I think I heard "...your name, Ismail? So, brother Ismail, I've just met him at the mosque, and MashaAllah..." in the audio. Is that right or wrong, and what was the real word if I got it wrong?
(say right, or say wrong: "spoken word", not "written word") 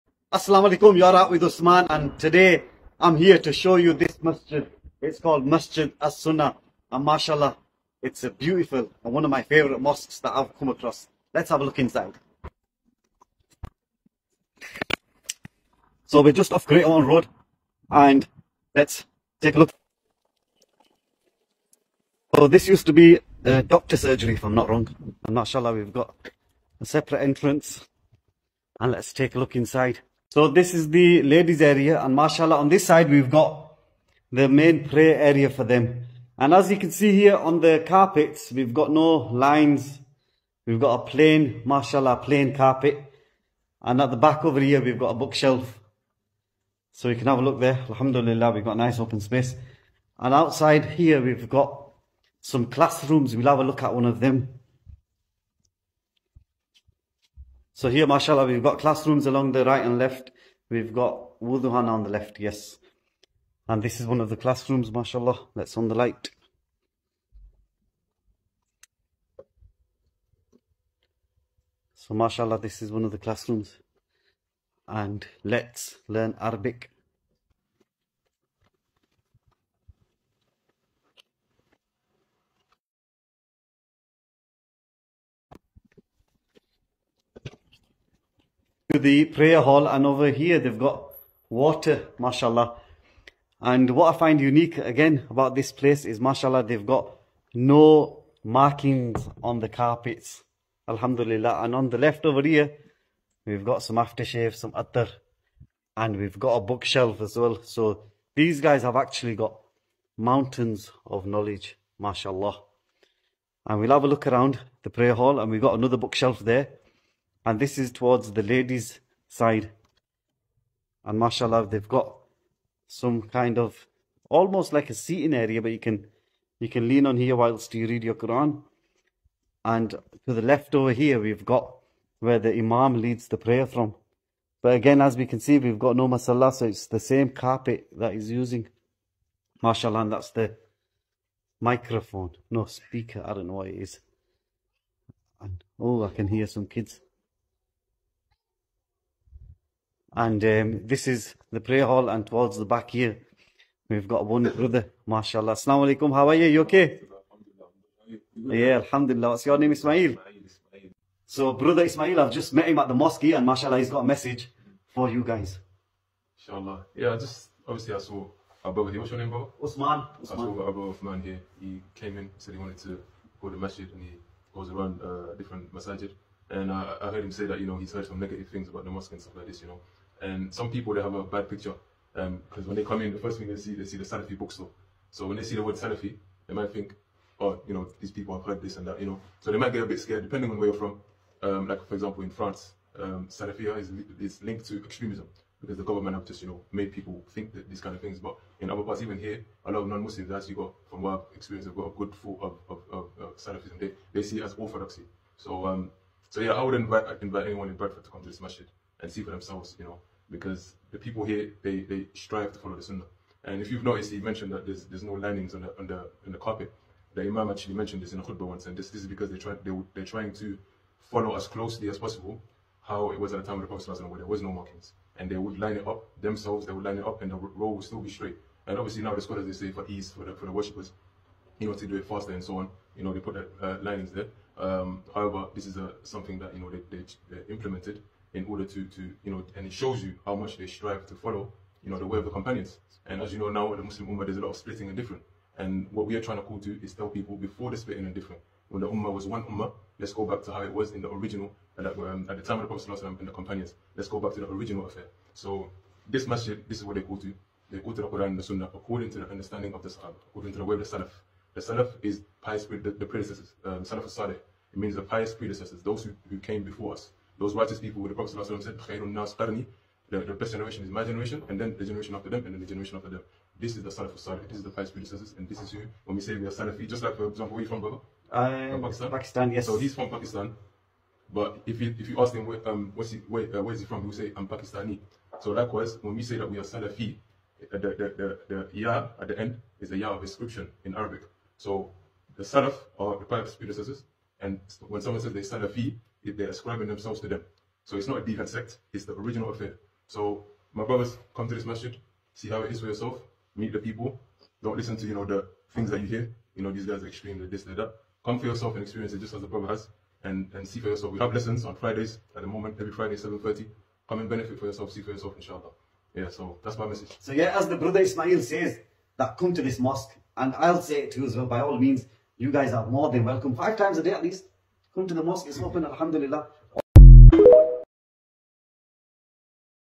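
right.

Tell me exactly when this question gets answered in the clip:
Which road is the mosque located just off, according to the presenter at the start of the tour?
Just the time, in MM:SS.
00:16.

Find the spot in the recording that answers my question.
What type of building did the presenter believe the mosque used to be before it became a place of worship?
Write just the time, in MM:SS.
00:23.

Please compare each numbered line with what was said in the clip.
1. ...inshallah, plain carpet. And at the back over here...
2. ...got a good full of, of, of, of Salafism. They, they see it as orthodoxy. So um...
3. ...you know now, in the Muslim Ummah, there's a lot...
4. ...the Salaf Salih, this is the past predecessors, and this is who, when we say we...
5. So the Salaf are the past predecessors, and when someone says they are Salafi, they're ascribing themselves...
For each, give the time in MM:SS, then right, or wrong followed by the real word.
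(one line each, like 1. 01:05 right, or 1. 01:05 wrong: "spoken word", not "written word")
1. 00:41 wrong: "mashallah", not "inshallah"
2. 03:21 right
3. 04:03 right
4. 04:33 right
5. 04:51 right.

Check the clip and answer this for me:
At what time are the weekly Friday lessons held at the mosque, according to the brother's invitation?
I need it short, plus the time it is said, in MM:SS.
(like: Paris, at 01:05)
7:30, at 05:13.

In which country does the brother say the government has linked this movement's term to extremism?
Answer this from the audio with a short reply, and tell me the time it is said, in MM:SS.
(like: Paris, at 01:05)
France, at 03:12.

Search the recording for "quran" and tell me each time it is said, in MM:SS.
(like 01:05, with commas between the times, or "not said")
02:08, 04:18.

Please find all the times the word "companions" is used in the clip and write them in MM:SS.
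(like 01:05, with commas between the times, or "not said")
04:02, 04:13.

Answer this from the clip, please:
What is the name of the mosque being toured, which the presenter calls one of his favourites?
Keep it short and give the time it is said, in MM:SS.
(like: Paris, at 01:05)
Masjid As-Sunnah, at 00:05.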